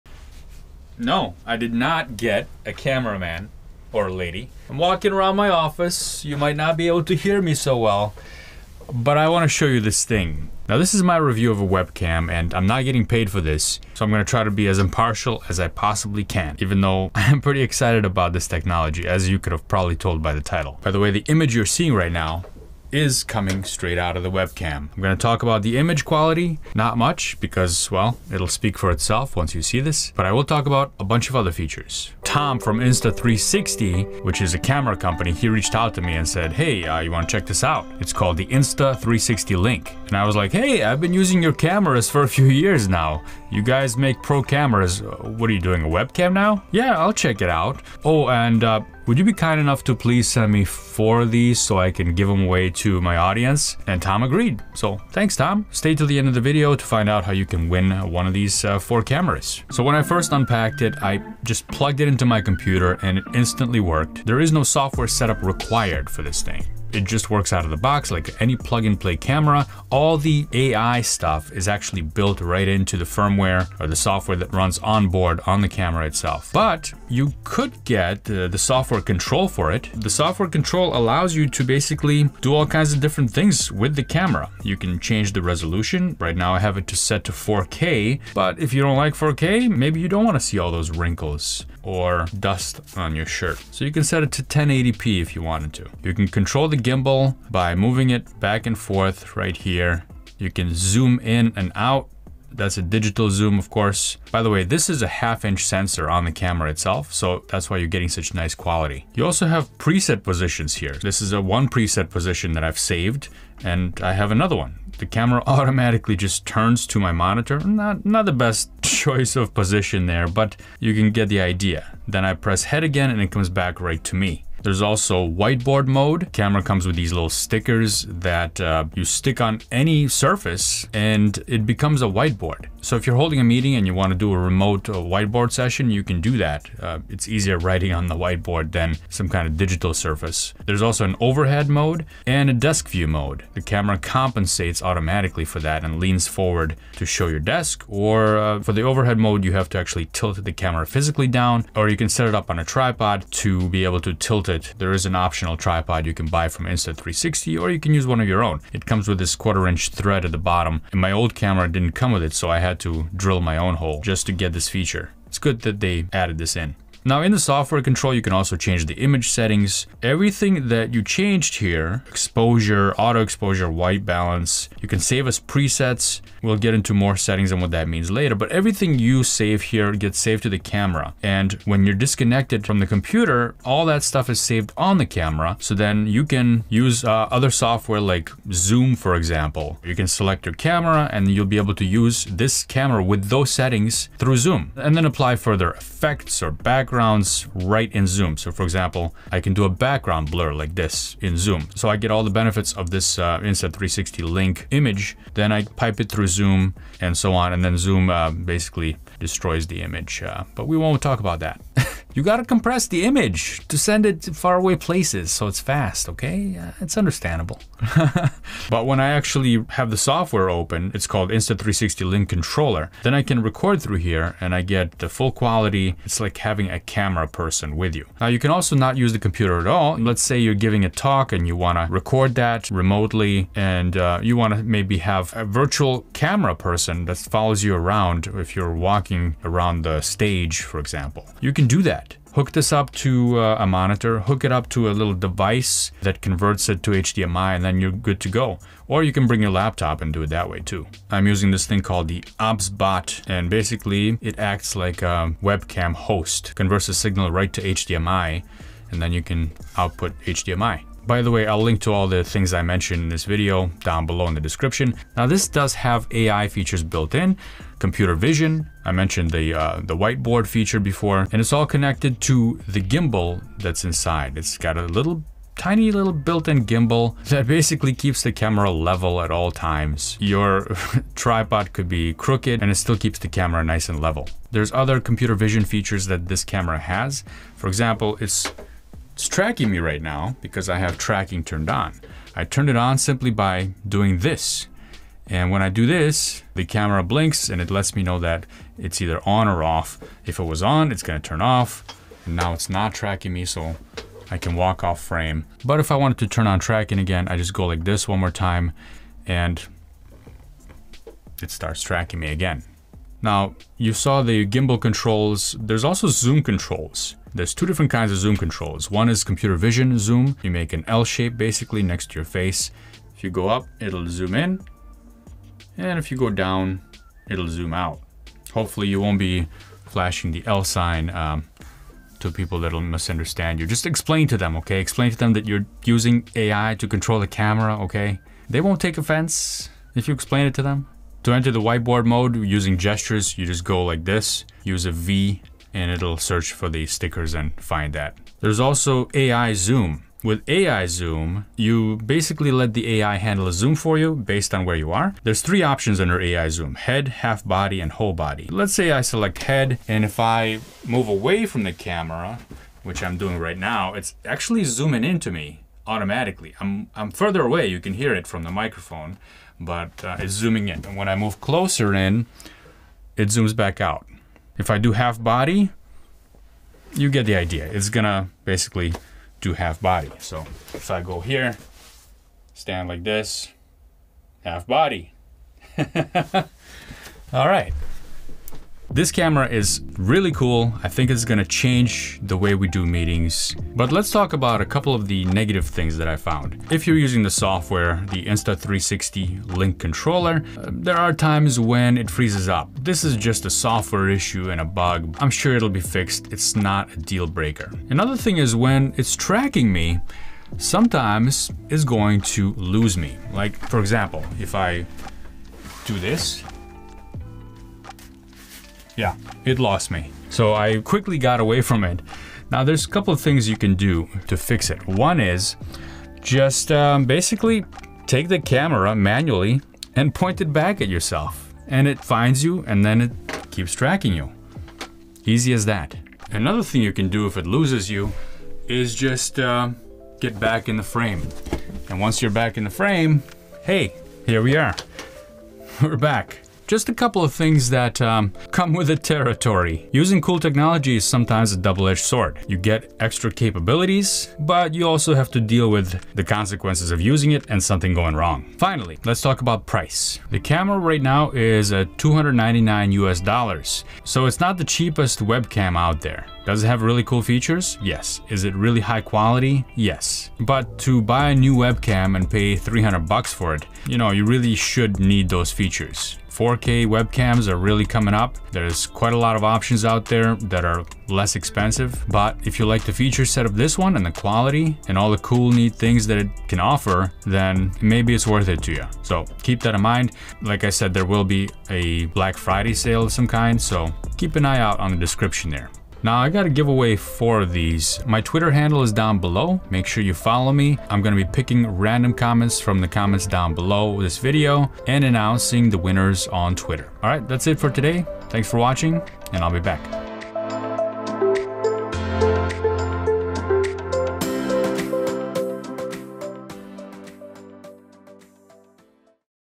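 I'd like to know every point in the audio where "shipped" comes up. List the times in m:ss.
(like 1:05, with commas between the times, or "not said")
not said.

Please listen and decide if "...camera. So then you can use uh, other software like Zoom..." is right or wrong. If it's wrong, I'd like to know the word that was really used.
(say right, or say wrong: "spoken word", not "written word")
right.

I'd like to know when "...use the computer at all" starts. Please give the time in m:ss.
3:48.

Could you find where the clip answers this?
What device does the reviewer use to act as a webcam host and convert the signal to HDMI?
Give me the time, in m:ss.
4:12.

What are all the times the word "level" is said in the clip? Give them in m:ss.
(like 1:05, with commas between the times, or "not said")
4:38, 4:44.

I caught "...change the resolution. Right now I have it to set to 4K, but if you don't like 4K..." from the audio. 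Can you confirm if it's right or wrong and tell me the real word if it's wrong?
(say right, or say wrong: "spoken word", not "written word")
right.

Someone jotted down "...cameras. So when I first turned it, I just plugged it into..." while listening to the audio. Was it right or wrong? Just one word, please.
wrong.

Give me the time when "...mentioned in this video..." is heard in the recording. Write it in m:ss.
4:22.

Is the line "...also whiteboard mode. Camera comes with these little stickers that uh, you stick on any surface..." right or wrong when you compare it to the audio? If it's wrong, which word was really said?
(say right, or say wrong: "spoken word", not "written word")
right.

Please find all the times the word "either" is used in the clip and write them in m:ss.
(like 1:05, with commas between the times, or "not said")
4:58.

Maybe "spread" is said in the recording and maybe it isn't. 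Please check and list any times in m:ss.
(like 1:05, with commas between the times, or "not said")
not said.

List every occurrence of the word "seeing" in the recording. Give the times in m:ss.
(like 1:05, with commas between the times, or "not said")
0:21.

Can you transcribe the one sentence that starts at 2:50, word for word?
Everything that you changed here, exposure, auto exposure, white balance, you can save as presets.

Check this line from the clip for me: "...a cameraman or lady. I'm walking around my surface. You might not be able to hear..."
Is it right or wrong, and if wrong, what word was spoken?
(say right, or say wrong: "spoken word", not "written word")
wrong: "office", not "surface".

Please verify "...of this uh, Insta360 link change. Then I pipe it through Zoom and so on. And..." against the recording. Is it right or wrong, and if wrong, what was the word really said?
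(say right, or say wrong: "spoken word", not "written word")
wrong: "image", not "change".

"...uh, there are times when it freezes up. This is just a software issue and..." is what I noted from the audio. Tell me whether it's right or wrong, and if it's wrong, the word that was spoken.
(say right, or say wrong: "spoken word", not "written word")
right.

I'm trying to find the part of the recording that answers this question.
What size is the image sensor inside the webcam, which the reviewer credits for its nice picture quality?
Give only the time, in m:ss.
1:45.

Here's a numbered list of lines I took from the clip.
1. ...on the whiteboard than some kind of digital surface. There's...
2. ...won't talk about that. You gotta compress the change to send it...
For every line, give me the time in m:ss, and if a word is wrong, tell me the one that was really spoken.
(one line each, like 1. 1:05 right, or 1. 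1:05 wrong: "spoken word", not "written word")
1. 2:17 right
2. 3:30 wrong: "image", not "change".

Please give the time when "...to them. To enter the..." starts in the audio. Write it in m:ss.
5:40.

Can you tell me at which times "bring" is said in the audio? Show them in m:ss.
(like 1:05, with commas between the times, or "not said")
4:09.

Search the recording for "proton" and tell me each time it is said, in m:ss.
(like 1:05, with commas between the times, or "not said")
not said.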